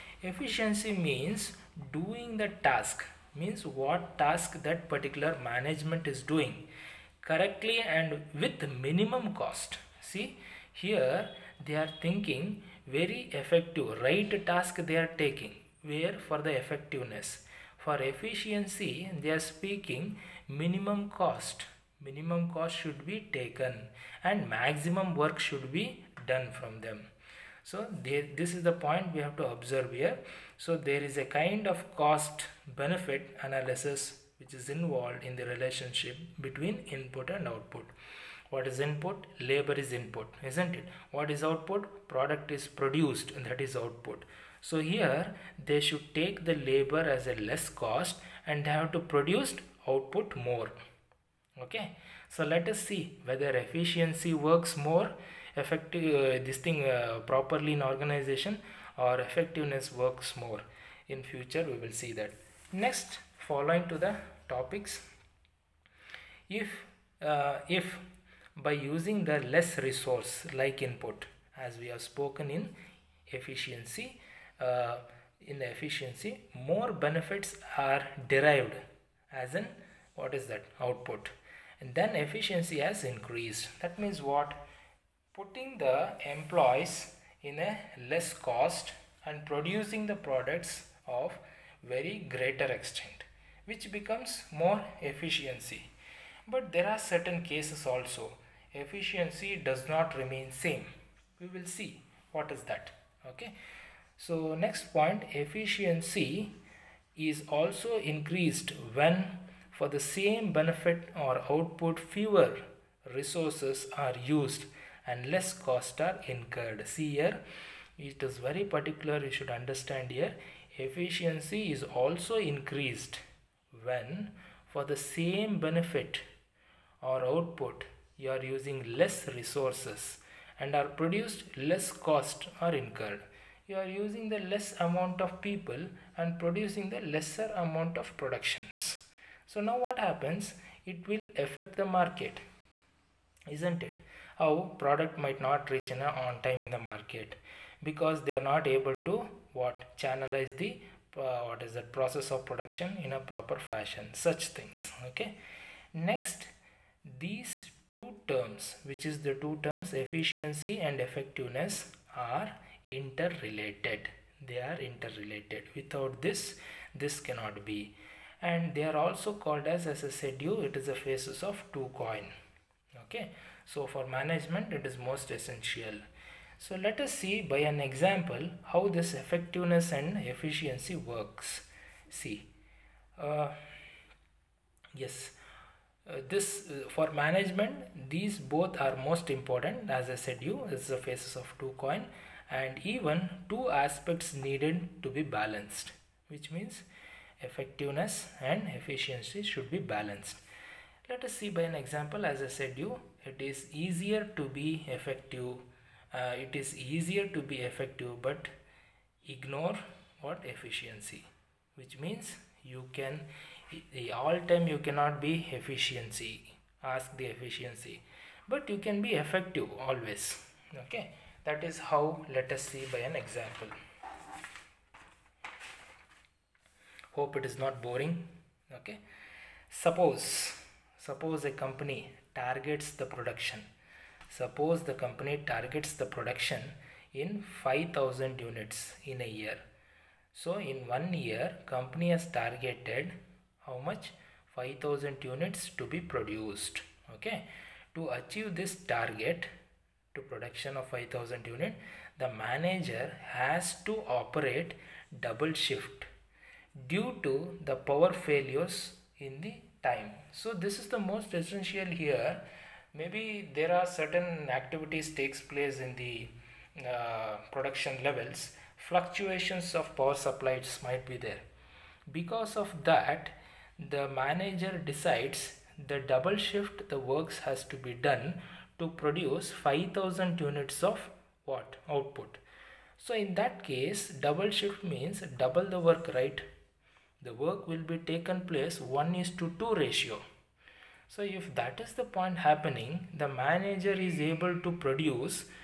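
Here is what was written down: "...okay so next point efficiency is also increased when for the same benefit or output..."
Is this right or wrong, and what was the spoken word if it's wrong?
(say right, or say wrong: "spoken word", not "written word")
right.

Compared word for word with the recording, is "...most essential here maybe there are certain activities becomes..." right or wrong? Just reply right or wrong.
wrong.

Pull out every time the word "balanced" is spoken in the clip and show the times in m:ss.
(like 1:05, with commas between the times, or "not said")
3:15, 3:19.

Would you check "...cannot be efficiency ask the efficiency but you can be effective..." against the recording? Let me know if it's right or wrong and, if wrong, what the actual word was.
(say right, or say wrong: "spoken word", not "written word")
right.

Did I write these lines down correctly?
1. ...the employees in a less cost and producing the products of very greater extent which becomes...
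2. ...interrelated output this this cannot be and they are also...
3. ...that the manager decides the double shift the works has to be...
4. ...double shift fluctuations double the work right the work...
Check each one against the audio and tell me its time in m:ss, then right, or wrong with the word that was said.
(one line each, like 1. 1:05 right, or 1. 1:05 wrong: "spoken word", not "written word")
1. 1:25 right
2. 2:44 wrong: "without", not "output"
3. 4:32 right
4. 4:44 wrong: "means", not "fluctuations".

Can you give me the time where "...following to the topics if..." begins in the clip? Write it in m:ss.
1:03.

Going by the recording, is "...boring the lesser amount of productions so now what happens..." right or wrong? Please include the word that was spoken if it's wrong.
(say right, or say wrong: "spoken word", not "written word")
wrong: "producing", not "boring".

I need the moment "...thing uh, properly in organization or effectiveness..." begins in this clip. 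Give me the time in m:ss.
0:56.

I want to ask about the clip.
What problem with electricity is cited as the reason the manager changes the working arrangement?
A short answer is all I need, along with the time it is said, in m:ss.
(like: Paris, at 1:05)
power failures, at 4:17.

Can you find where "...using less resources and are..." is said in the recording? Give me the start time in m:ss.
2:08.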